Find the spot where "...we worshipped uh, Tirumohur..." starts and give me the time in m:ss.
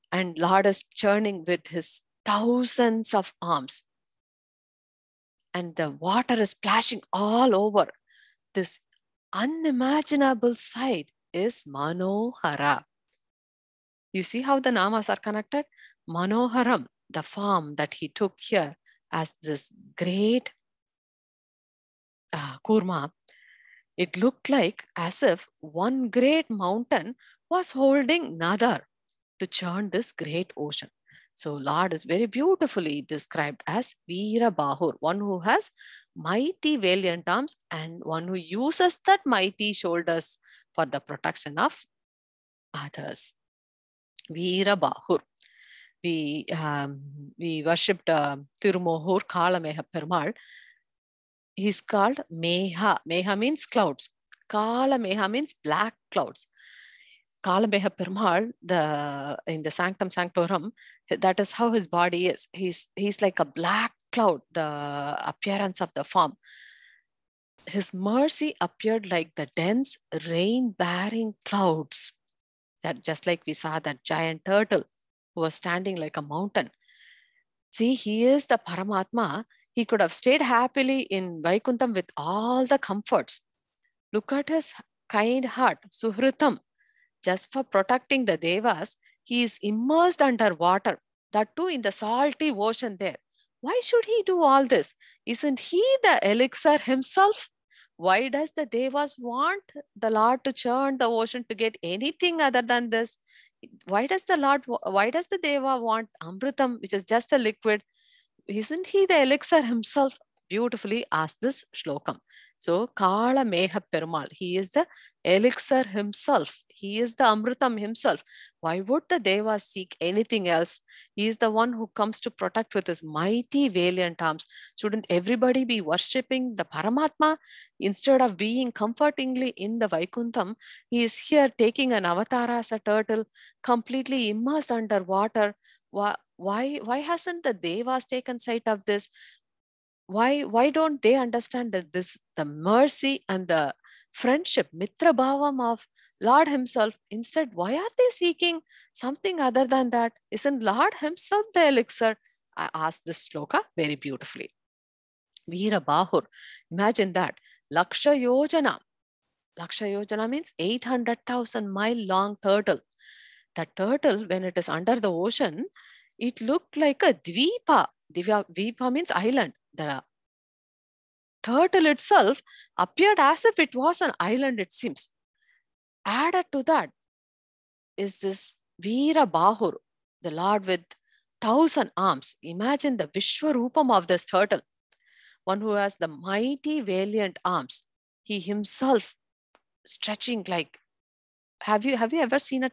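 0:47.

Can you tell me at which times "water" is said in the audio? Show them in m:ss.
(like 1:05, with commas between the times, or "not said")
0:05, 1:30, 2:15.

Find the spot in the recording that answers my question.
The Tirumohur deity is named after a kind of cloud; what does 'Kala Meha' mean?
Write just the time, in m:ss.
0:55.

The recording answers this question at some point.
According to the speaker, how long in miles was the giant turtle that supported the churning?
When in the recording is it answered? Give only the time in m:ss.
2:40.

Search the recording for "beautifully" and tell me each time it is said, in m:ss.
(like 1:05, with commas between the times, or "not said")
0:32, 1:50, 2:33.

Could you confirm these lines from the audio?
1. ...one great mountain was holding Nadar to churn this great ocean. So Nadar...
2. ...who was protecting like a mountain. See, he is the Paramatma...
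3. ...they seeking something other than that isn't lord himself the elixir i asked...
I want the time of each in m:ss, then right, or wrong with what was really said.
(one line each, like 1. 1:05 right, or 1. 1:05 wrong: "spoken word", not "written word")
1. 0:25 wrong: "Lord", not "Nadar"
2. 1:15 wrong: "standing", not "protecting"
3. 2:27 right.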